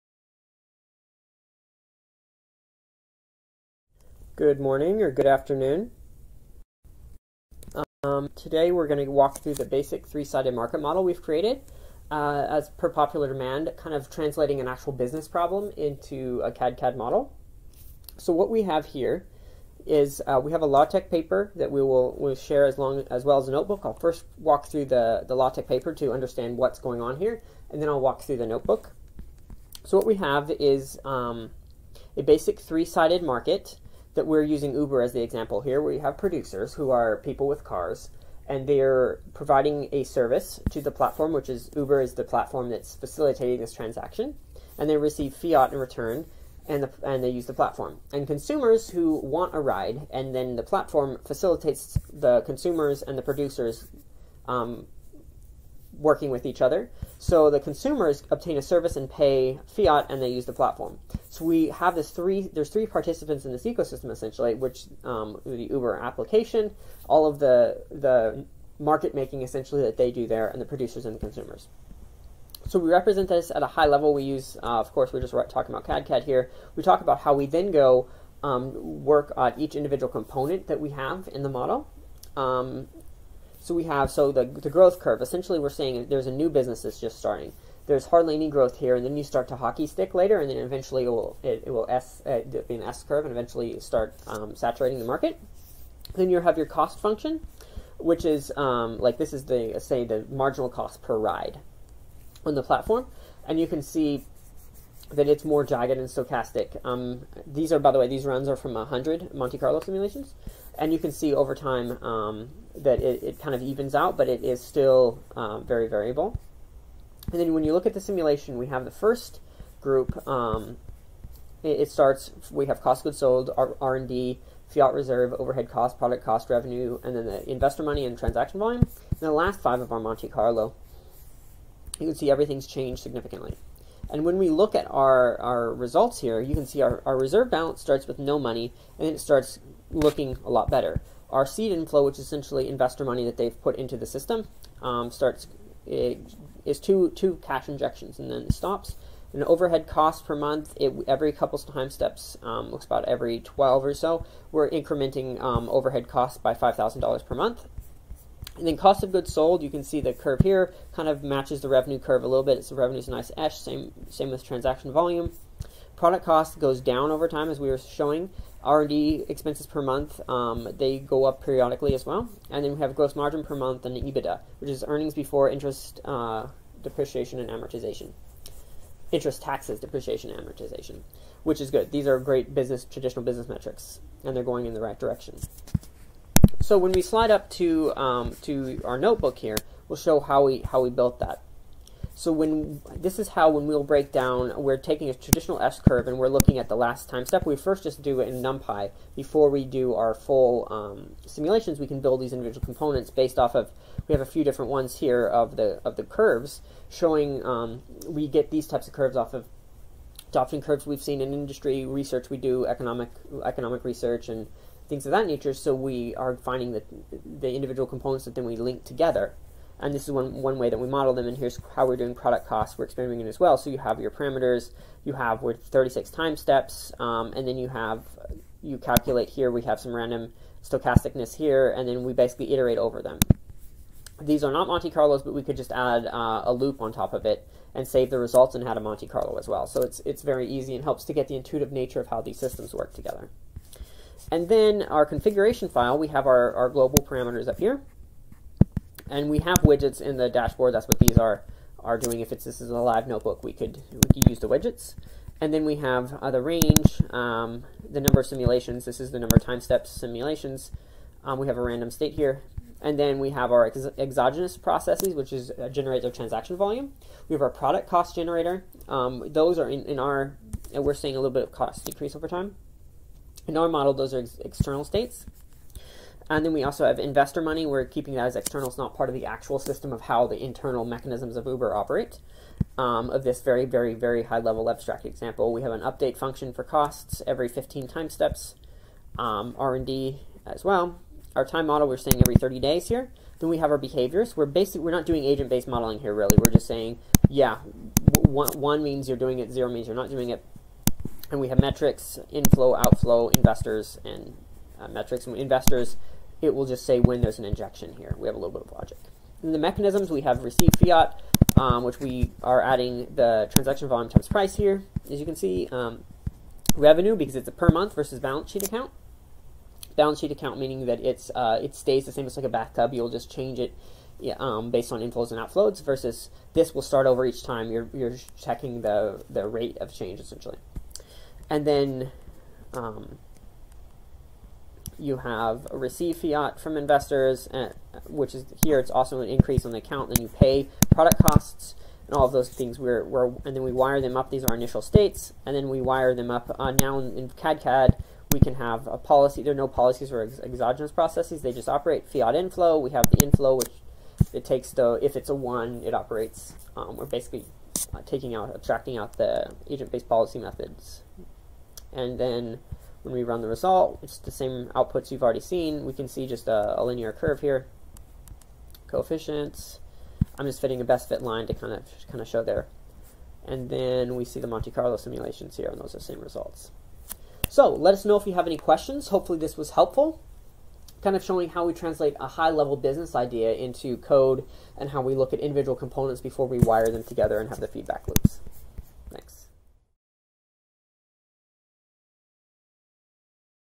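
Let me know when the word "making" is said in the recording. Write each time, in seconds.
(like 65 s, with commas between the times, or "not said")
69 s.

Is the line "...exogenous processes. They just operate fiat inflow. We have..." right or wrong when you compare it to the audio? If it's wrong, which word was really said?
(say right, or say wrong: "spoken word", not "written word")
right.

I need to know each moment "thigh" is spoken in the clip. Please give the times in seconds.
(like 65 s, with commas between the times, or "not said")
not said.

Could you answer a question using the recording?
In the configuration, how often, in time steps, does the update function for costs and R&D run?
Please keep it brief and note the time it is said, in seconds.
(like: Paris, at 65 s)
Every 15 time steps, at 287 s.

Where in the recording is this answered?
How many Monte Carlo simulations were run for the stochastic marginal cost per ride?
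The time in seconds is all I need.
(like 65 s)
108 s.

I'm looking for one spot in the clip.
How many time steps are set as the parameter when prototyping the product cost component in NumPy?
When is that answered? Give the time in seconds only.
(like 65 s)
225 s.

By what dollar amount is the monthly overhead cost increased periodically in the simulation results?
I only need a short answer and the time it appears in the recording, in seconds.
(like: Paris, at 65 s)
$5,000, at 156 s.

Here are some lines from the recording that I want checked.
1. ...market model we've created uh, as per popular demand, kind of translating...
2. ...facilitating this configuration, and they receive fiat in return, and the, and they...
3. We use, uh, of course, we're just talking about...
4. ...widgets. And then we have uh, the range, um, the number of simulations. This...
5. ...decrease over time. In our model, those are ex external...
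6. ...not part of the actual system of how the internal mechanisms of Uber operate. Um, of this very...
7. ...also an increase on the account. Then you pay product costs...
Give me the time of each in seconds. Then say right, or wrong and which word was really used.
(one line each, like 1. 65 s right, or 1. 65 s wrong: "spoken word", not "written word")
1. 10 s right
2. 42 s wrong: "transaction", not "configuration"
3. 74 s right
4. 254 s right
5. 271 s right
6. 278 s right
7. 338 s right.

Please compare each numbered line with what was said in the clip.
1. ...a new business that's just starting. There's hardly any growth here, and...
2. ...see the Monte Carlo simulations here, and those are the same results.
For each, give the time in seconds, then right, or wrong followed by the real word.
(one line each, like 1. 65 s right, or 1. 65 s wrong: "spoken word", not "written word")
1. 86 s right
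2. 374 s right.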